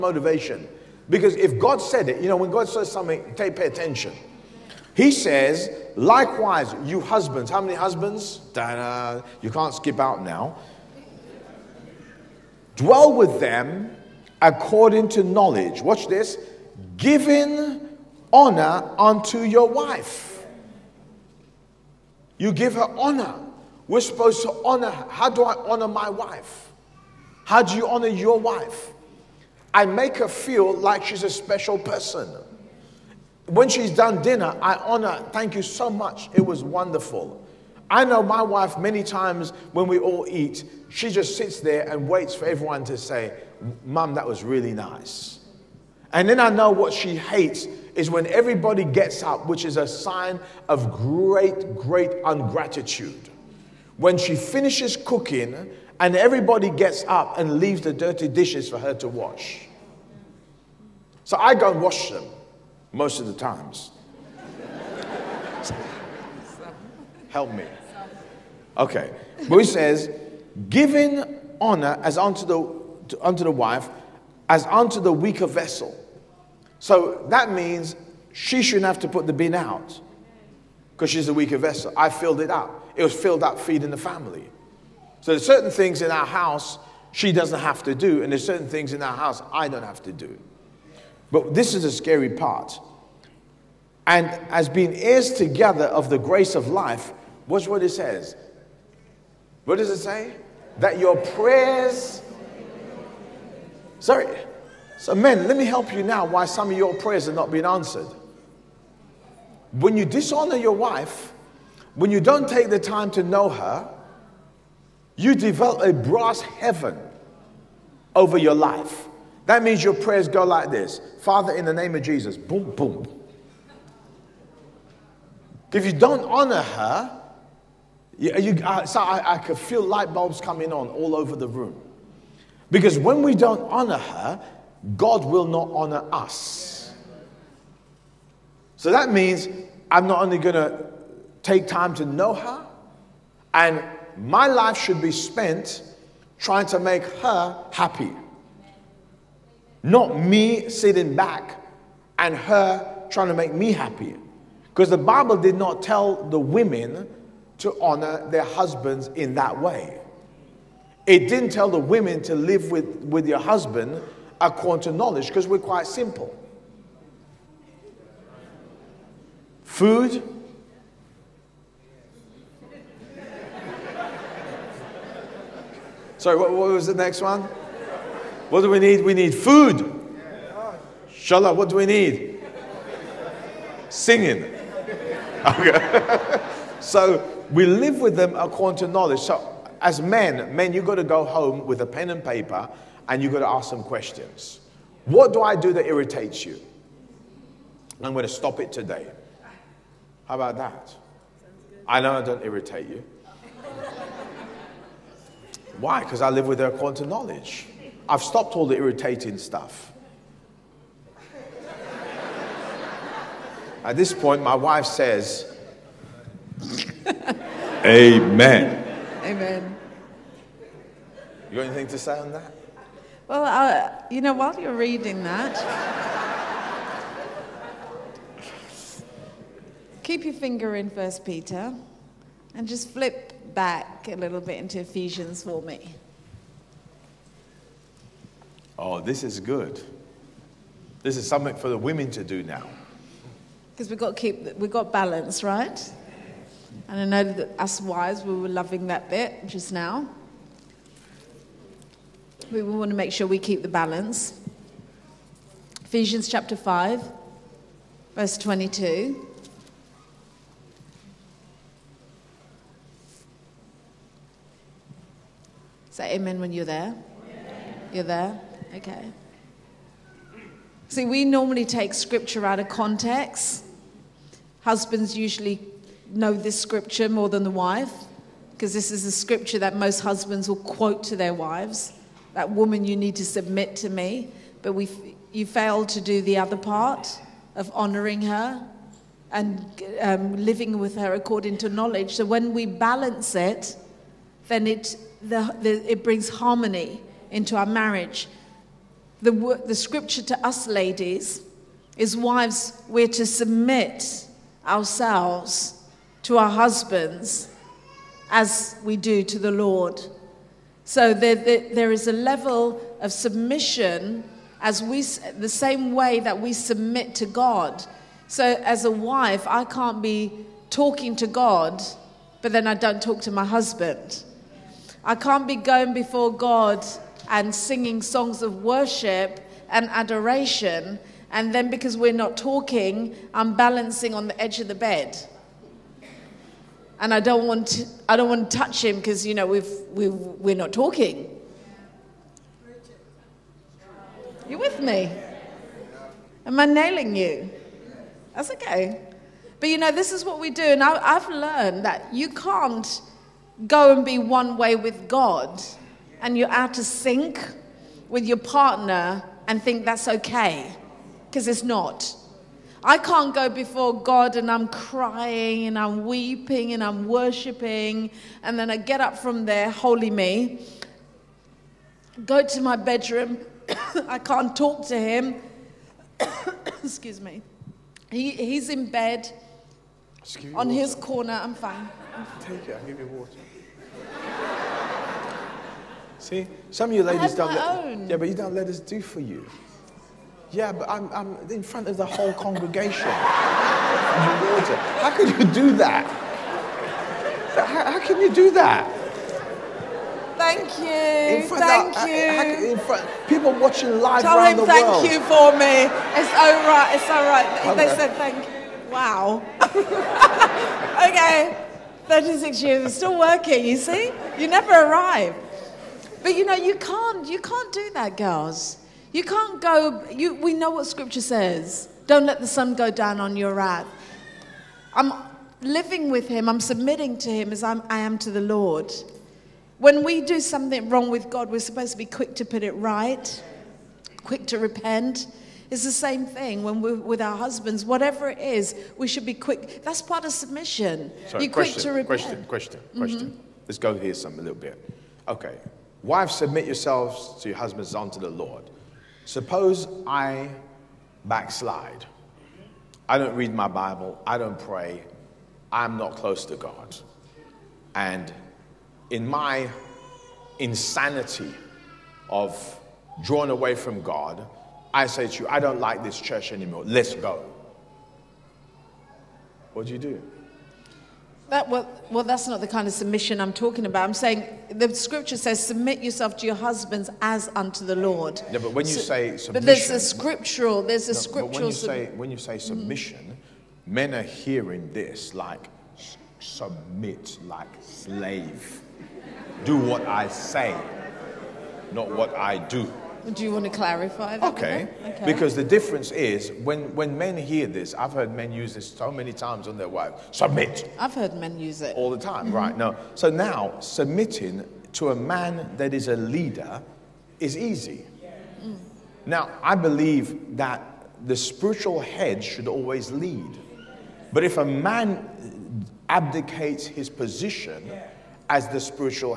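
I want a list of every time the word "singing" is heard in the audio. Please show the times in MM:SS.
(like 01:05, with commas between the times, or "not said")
03:03, 05:27.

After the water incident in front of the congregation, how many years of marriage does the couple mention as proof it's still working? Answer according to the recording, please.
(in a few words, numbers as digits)
36 years.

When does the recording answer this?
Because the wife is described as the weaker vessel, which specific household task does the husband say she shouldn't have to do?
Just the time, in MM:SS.
01:19.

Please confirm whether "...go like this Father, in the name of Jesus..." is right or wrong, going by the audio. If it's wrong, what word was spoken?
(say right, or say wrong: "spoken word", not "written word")
right.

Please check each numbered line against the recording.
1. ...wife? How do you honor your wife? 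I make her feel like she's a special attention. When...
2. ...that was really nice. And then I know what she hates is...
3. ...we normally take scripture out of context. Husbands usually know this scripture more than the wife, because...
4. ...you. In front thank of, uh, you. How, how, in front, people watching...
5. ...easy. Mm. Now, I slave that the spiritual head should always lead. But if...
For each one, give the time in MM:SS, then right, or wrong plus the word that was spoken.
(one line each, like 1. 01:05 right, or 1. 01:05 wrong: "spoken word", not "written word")
1. 00:26 wrong: "person", not "attention"
2. 00:44 right
3. 04:31 right
4. 06:40 right
5. 08:27 wrong: "believe", not "slave".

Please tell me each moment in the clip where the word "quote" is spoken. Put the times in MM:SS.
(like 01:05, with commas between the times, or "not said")
04:40.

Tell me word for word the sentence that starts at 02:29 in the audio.
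Not me sitting back and her trying to make me happy.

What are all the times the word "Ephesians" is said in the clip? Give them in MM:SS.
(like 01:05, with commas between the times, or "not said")
03:54, 04:15.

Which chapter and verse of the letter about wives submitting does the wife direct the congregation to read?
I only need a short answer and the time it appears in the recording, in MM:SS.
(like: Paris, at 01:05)
Chapter 5, verse 22, at 04:16.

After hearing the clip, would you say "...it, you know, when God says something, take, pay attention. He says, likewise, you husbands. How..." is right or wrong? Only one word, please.
right.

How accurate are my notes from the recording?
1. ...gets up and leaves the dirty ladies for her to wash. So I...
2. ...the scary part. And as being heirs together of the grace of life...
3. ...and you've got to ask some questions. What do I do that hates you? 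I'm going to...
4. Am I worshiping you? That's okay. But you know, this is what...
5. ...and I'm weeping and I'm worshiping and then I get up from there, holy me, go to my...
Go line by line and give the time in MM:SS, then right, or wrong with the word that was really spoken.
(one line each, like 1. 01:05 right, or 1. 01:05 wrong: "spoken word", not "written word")
1. 00:56 wrong: "dishes", not "ladies"
2. 01:31 right
3. 03:13 wrong: "irritates", not "hates"
4. 05:46 wrong: "nailing", not "worshiping"
5. 06:05 right.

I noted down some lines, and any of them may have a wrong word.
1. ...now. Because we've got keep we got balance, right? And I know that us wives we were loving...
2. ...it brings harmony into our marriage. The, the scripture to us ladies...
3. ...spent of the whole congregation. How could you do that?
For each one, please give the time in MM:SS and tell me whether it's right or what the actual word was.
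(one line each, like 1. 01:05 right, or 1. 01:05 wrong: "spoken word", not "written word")
1. 04:02 right
2. 04:55 right
3. 06:31 wrong: "front", not "spent".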